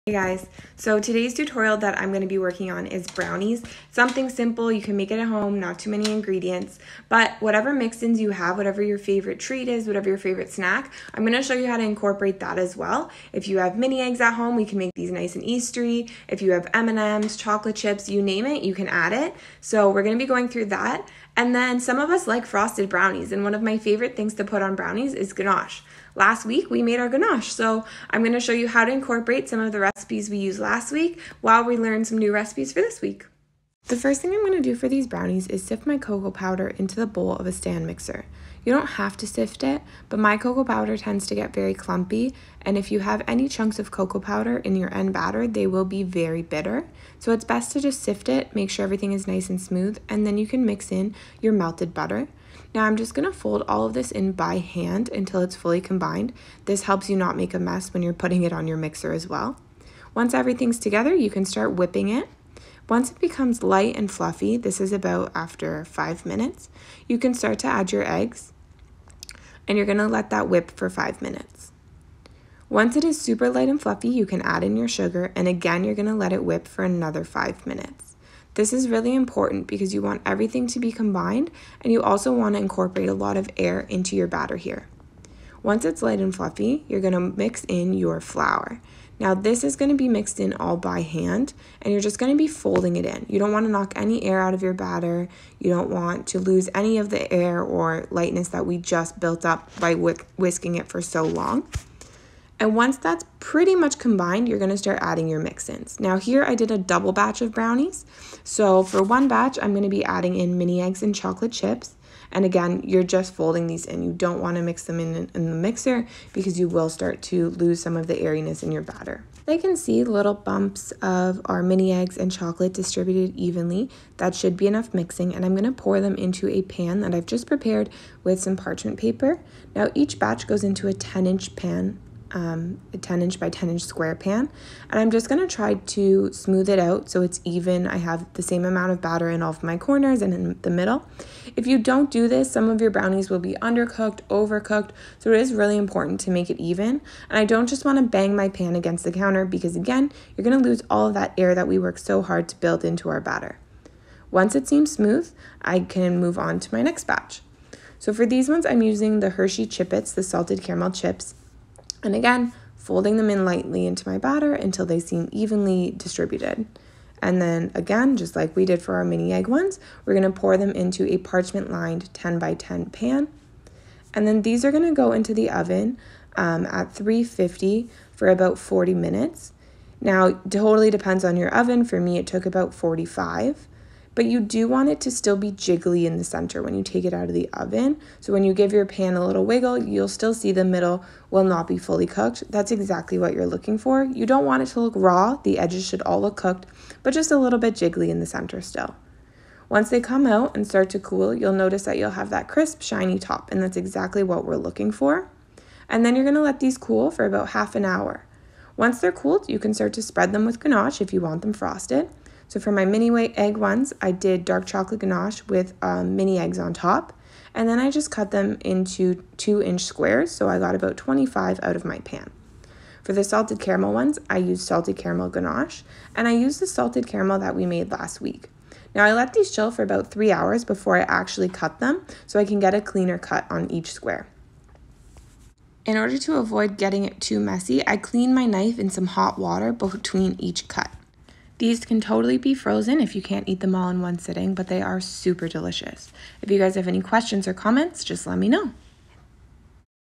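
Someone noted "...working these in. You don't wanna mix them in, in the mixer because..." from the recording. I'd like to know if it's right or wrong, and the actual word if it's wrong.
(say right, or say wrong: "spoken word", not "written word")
wrong: "folding", not "working".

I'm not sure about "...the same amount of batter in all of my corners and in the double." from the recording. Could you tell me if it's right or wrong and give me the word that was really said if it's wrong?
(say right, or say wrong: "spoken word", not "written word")
wrong: "middle", not "double".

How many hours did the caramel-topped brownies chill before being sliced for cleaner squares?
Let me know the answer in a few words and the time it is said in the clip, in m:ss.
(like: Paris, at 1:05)
3, at 3:50.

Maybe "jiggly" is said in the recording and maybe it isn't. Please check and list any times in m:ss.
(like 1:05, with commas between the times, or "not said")
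3:05, 3:17.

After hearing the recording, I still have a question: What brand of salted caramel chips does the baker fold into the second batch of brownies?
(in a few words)
Hershey Chippets.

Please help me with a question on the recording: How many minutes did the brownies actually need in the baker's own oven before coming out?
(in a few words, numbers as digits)
45.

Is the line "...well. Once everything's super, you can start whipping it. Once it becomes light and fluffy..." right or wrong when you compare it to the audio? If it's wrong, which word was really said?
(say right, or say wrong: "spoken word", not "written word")
wrong: "together", not "super".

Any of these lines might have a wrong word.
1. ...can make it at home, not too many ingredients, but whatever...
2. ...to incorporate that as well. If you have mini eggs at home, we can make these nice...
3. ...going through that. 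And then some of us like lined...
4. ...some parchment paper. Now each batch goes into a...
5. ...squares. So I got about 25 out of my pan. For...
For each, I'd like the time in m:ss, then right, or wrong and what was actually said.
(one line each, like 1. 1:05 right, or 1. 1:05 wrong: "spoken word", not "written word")
1. 0:04 right
2. 0:11 right
3. 0:20 wrong: "frosted", not "lined"
4. 2:08 right
5. 3:39 right.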